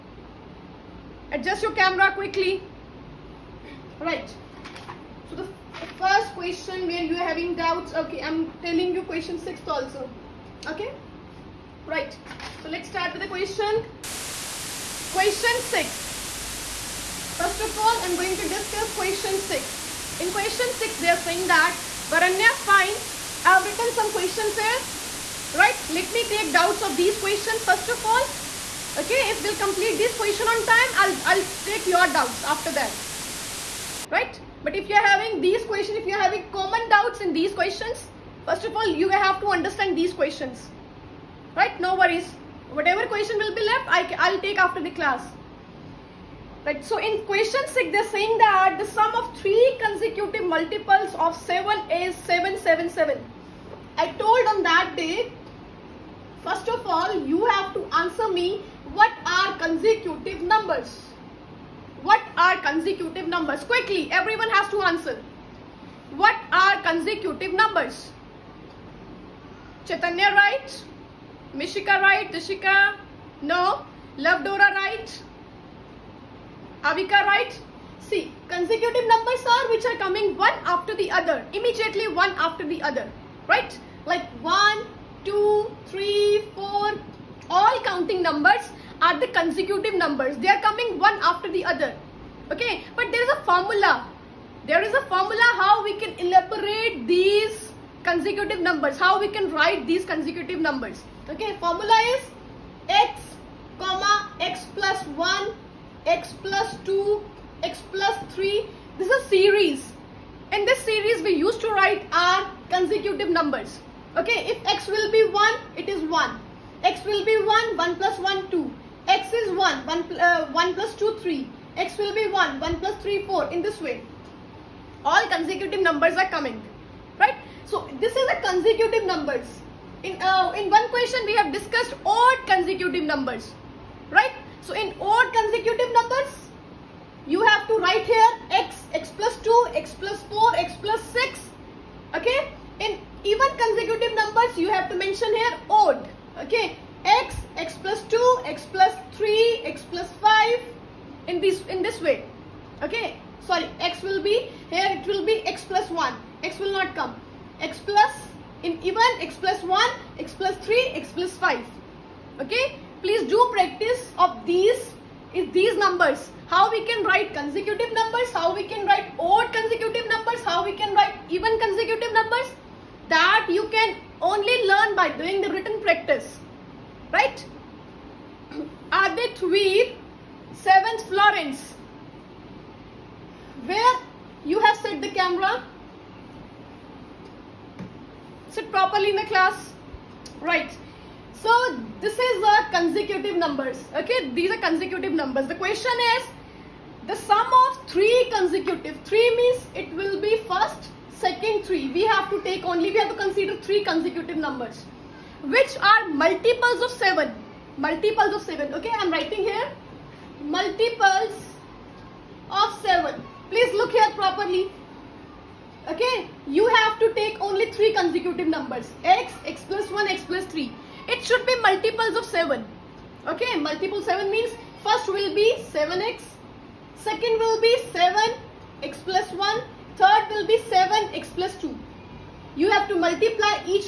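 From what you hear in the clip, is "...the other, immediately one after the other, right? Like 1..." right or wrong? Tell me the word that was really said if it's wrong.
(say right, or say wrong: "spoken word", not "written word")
right.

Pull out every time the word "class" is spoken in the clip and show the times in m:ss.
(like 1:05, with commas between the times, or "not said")
0:44, 3:09.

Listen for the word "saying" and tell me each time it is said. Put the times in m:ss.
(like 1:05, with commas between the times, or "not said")
0:21, 0:48.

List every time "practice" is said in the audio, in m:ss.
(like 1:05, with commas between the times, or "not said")
2:43, 2:55.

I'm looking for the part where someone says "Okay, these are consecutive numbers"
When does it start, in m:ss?
3:13.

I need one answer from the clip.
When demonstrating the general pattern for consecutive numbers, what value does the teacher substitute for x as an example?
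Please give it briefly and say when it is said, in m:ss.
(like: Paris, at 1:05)
1, at 1:54.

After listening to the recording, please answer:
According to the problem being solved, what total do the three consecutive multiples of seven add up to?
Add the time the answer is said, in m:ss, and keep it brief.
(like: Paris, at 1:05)
777, at 0:52.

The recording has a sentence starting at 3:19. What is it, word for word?
Three means it will be first, second, three.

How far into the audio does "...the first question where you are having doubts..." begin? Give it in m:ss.
0:05.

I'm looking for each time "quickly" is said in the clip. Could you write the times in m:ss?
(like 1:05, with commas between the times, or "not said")
0:02, 1:03.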